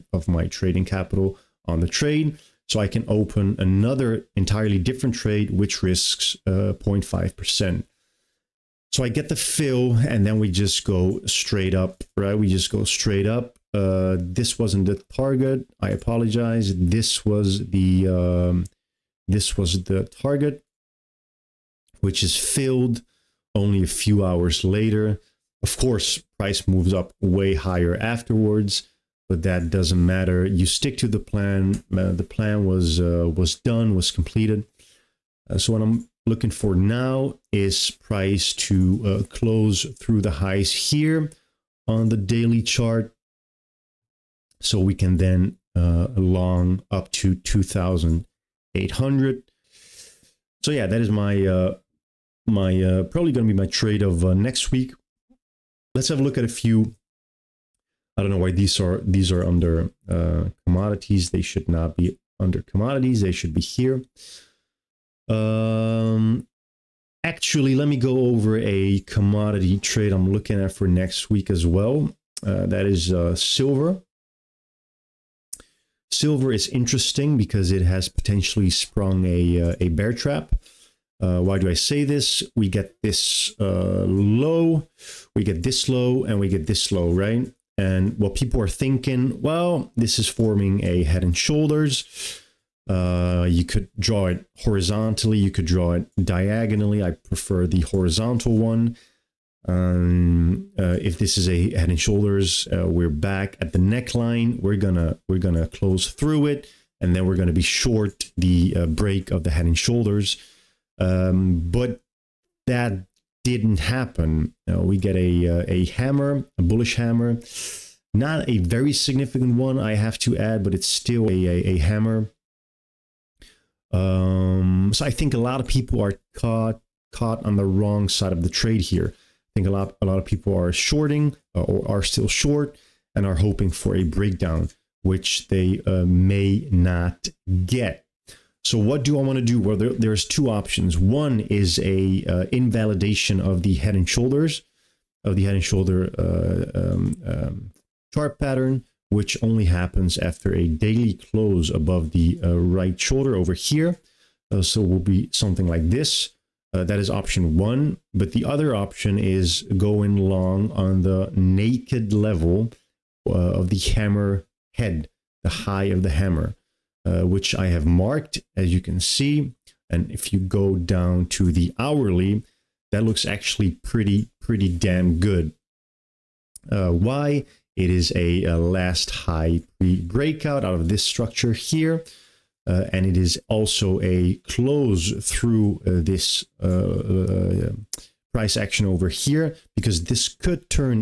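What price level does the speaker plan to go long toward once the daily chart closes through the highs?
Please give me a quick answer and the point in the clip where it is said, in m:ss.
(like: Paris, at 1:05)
2,800, at 0:47.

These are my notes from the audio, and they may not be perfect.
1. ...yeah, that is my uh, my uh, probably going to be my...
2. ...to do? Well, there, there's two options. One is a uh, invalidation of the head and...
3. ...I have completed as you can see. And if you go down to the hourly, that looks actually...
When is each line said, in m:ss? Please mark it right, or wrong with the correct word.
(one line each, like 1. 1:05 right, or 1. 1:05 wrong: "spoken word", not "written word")
1. 0:50 right
2. 2:19 right
3. 2:47 wrong: "marked", not "completed".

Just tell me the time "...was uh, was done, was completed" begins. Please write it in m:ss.
0:32.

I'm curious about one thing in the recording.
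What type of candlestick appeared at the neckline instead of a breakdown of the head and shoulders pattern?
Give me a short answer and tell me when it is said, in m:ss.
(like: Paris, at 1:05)
Bullish hammer, at 1:56.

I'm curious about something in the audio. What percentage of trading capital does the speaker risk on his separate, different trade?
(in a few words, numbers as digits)
0.5%.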